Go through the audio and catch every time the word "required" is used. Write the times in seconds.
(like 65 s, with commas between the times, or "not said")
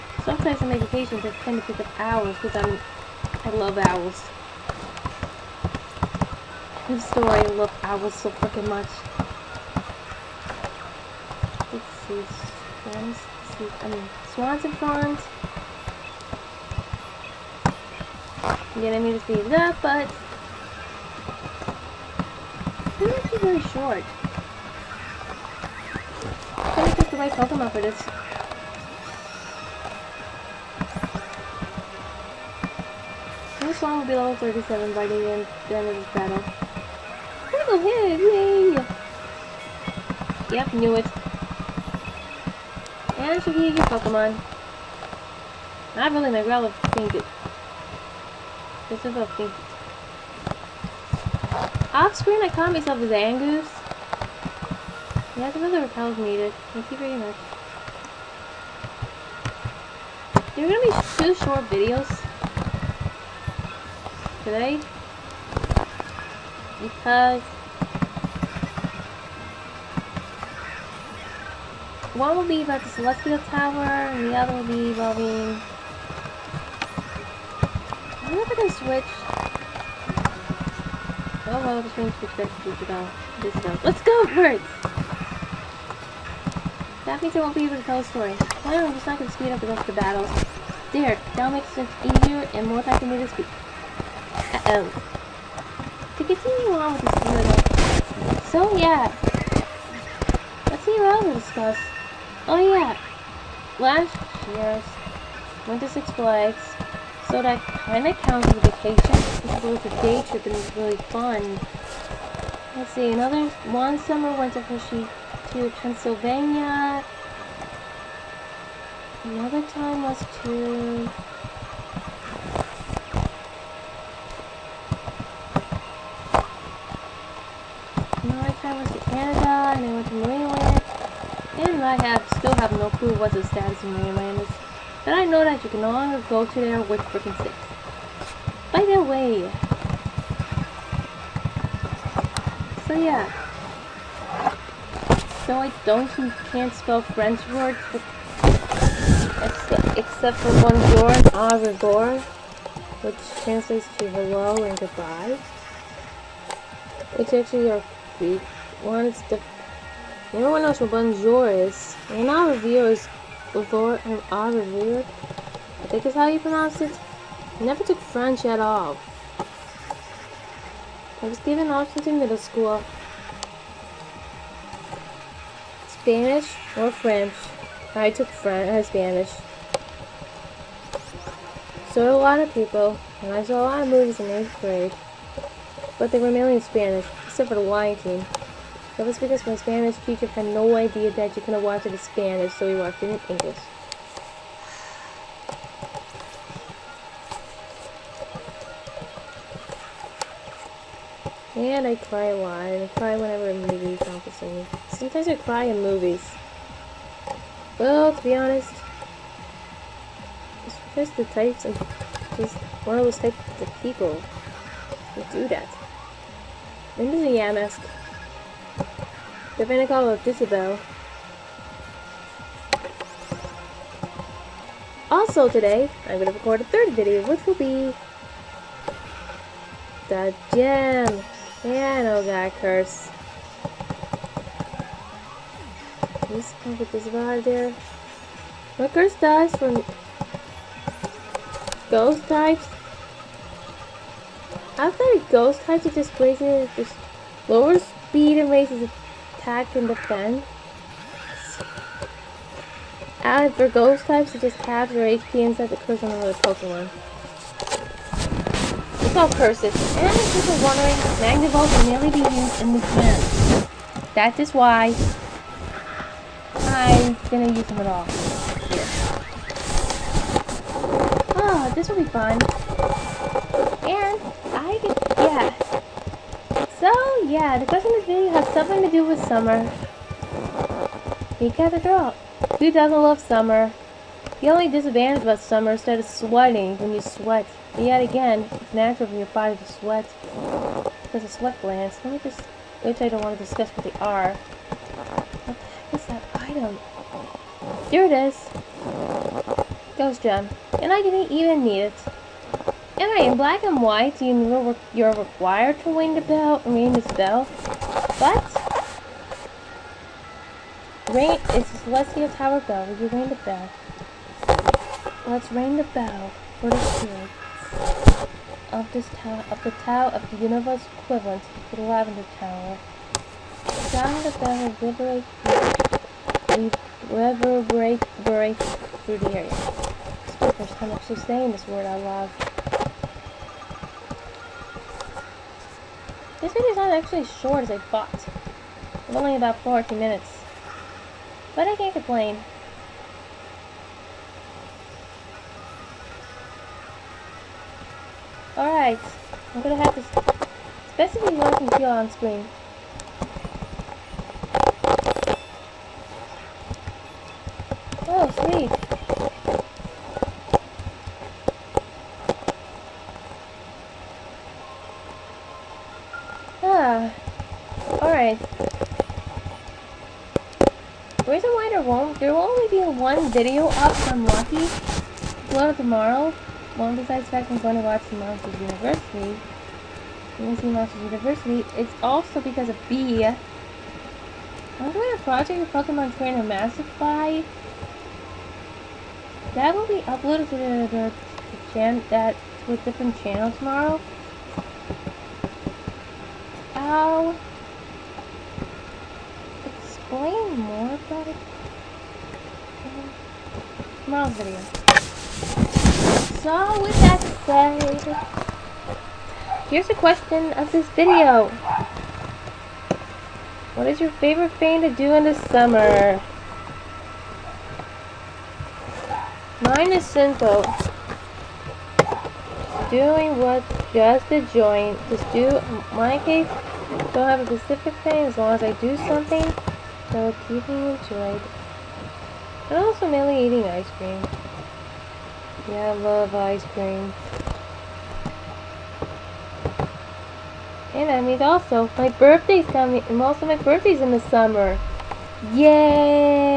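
305 s.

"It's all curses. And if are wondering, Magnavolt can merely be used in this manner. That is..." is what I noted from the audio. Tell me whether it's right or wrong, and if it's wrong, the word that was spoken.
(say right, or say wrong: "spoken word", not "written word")
right.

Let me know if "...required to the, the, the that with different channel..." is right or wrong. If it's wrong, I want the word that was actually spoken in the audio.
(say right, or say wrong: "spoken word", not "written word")
wrong: "uploaded", not "required".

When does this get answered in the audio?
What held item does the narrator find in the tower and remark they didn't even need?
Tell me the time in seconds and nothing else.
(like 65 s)
299 s.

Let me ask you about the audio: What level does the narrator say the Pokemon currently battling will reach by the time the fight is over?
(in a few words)
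37.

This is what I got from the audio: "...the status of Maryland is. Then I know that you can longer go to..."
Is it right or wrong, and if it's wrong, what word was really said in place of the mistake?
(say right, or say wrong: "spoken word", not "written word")
right.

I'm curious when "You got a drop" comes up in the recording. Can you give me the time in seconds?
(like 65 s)
281 s.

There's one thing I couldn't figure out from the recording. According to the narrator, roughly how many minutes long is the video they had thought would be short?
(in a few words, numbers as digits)
40 minutes.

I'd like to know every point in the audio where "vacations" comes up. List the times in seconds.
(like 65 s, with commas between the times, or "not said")
0 s, 108 s.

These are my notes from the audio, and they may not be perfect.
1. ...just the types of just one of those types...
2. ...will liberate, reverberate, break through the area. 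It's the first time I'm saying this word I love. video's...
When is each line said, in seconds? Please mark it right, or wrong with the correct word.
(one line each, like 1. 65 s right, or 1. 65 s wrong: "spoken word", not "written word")
1. 210 s right
2. 324 s right.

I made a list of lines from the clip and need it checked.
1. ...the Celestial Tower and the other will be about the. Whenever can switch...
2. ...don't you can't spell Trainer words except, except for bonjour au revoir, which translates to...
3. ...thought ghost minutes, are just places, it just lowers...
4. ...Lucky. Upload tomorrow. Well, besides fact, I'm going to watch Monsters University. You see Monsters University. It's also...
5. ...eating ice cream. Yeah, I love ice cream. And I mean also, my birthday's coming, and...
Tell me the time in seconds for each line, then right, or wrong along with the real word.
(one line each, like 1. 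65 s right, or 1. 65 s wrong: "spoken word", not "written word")
1. 72 s right
2. 145 s wrong: "French", not "Trainer"
3. 244 s wrong: "types", not "minutes"
4. 374 s right
5. 433 s right.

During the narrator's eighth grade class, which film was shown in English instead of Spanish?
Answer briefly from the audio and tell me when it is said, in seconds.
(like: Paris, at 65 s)
The Lion King, at 187 s.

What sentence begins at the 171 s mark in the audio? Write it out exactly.
I was given options in middle school, Spanish or French.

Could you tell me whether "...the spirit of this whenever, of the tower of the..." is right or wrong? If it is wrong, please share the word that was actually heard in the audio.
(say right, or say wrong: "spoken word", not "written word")
wrong: "tower", not "whenever".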